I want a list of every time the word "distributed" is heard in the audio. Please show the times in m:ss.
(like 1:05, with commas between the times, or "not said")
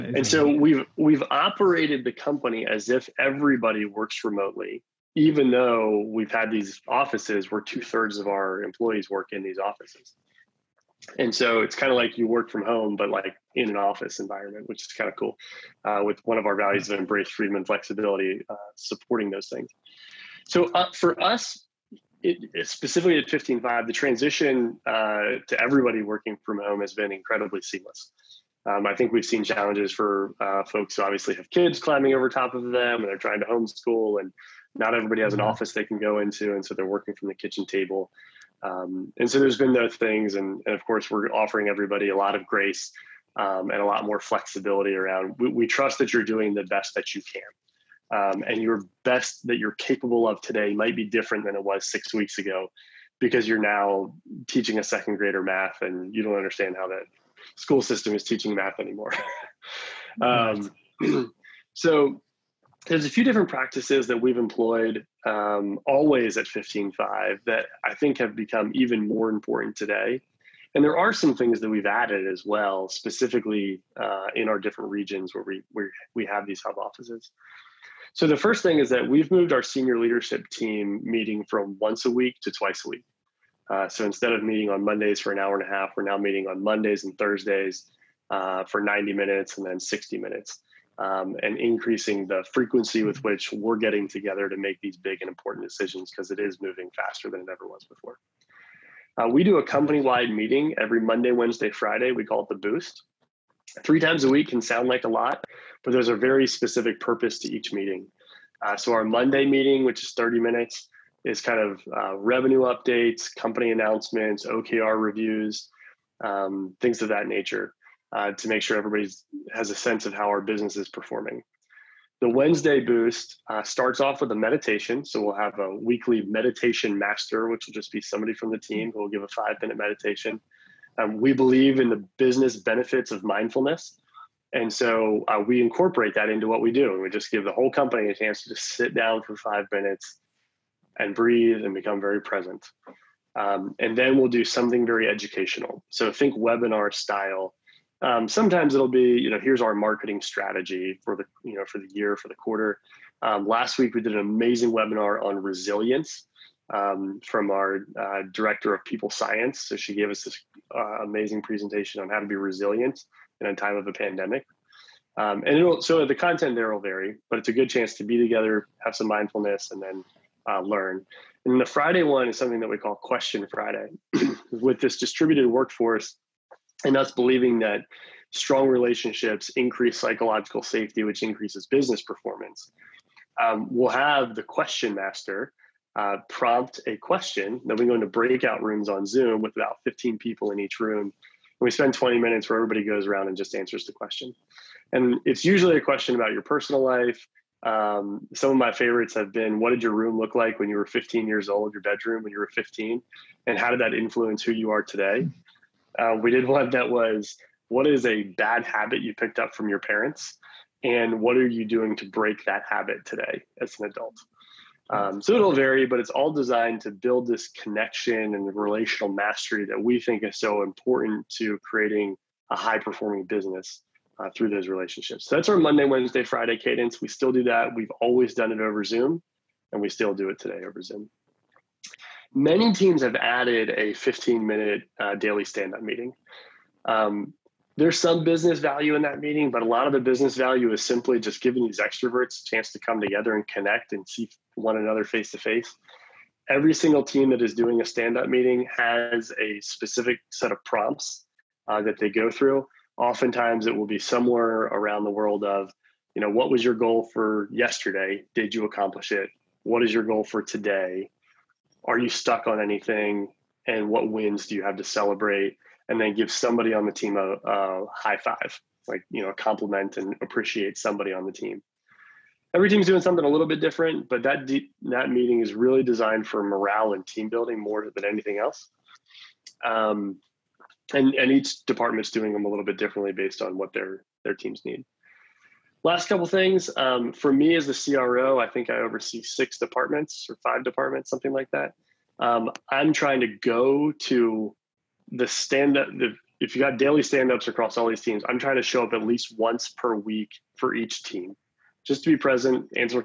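2:54.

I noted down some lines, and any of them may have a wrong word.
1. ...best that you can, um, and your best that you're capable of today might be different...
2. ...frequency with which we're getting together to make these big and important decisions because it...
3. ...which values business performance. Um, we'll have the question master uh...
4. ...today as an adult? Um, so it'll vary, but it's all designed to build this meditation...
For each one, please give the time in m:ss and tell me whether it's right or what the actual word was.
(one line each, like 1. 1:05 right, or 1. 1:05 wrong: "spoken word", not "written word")
1. 0:46 right
2. 1:32 right
3. 3:01 wrong: "increases", not "values"
4. 3:33 wrong: "connection", not "meditation".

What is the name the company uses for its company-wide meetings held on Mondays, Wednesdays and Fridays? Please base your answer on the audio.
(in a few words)
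the Boost.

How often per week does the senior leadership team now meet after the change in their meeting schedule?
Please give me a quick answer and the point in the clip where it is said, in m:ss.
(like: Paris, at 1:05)
twice a week, at 1:22.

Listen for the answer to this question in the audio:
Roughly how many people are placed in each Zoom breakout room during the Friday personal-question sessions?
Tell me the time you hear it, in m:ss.
3:09.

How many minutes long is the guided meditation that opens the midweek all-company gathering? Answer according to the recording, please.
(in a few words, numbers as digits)
5.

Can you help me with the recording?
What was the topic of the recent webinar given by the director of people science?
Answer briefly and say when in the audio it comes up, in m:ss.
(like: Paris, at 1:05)
resilience, at 2:35.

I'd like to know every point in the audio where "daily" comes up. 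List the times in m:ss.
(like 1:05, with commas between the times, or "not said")
3:55, 4:56.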